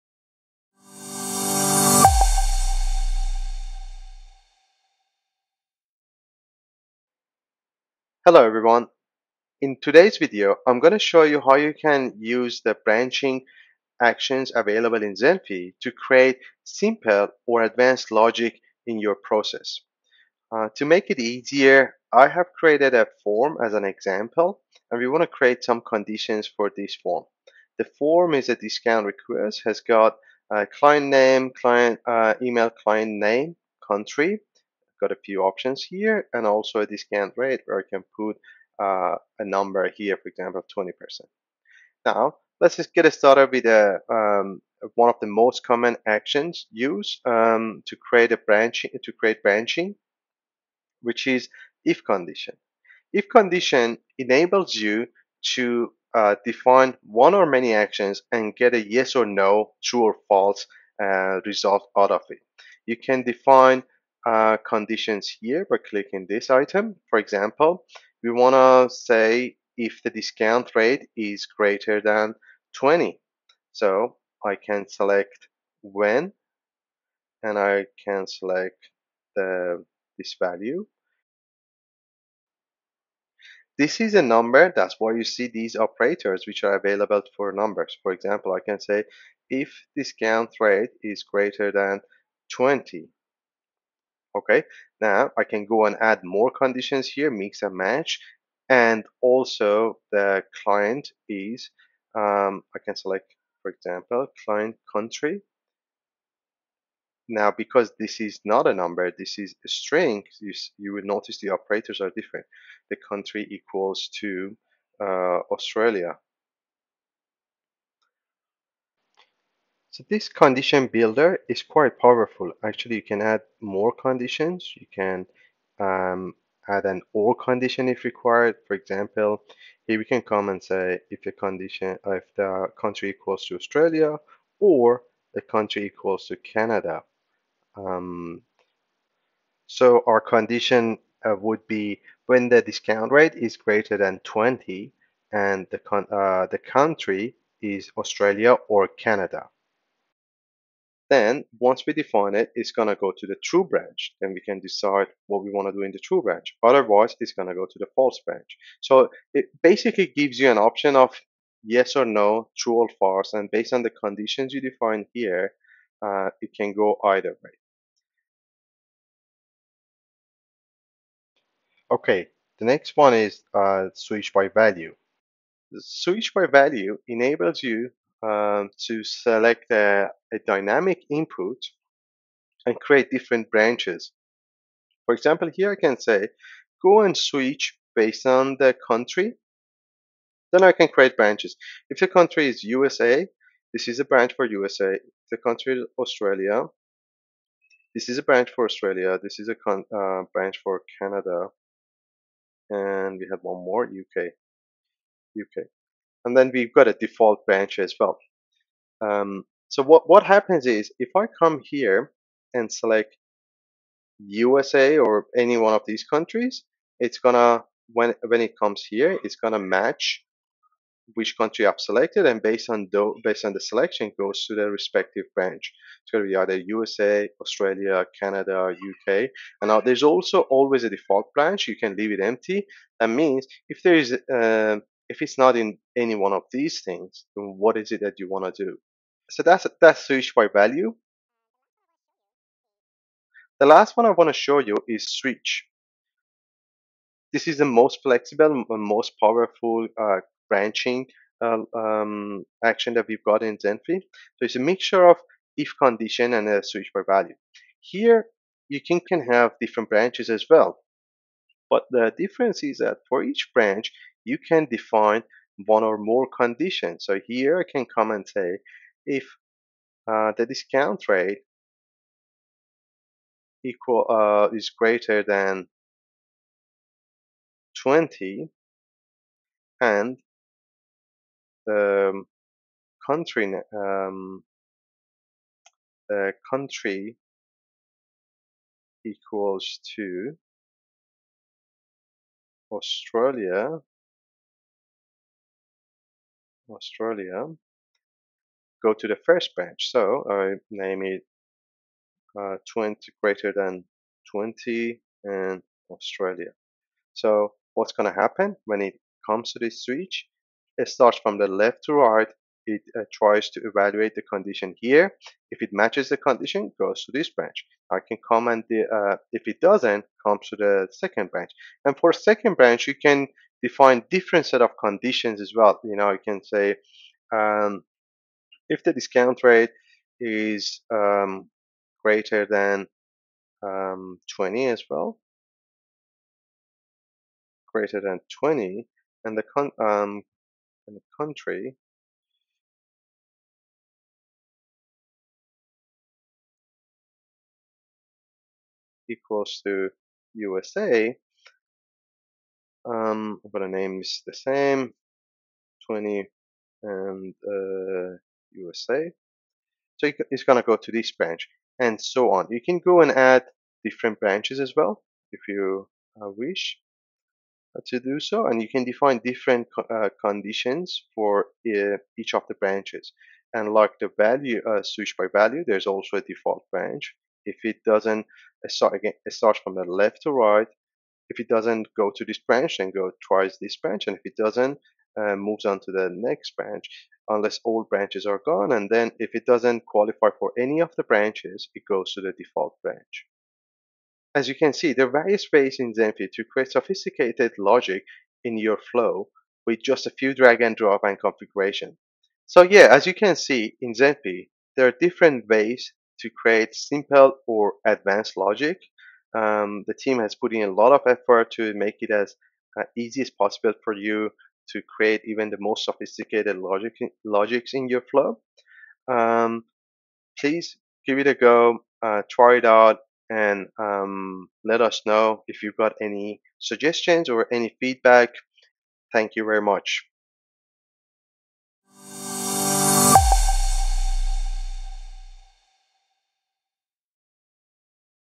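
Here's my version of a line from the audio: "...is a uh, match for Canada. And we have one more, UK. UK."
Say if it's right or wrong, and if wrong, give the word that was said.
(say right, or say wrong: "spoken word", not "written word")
wrong: "branch", not "match".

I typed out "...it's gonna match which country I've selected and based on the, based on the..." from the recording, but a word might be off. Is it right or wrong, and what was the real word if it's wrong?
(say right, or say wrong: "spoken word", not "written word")
right.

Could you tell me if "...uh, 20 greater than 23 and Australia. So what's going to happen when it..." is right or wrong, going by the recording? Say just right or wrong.
wrong.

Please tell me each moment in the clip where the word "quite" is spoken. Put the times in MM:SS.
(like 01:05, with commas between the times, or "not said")
02:01.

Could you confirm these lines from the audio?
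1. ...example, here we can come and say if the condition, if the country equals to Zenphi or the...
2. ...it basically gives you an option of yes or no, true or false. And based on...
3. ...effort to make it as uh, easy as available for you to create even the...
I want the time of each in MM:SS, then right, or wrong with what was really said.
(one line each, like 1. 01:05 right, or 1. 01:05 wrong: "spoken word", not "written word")
1. 02:08 wrong: "Australia", not "Zenphi"
2. 02:39 right
3. 06:51 wrong: "possible", not "available".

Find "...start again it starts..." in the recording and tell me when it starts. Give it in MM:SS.
06:18.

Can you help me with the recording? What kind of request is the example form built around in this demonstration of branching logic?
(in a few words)
Discount request.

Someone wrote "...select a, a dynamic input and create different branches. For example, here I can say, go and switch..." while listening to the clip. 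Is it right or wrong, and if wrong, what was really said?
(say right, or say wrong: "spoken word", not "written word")
right.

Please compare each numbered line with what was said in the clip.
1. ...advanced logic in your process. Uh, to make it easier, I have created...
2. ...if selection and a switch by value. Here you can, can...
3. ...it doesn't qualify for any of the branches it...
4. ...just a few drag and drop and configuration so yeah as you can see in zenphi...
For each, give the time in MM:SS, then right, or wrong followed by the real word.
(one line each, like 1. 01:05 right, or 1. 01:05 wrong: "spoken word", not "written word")
1. 00:17 right
2. 04:15 wrong: "condition", not "selection"
3. 06:29 right
4. 06:39 right.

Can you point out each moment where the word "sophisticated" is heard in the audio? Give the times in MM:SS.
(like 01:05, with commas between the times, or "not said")
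06:36, 06:55.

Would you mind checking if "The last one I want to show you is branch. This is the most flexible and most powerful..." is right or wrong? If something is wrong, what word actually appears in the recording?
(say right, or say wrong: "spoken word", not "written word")
wrong: "switch", not "branch".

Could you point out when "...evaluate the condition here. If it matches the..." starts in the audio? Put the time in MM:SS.
05:13.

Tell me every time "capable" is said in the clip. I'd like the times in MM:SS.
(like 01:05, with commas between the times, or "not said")
not said.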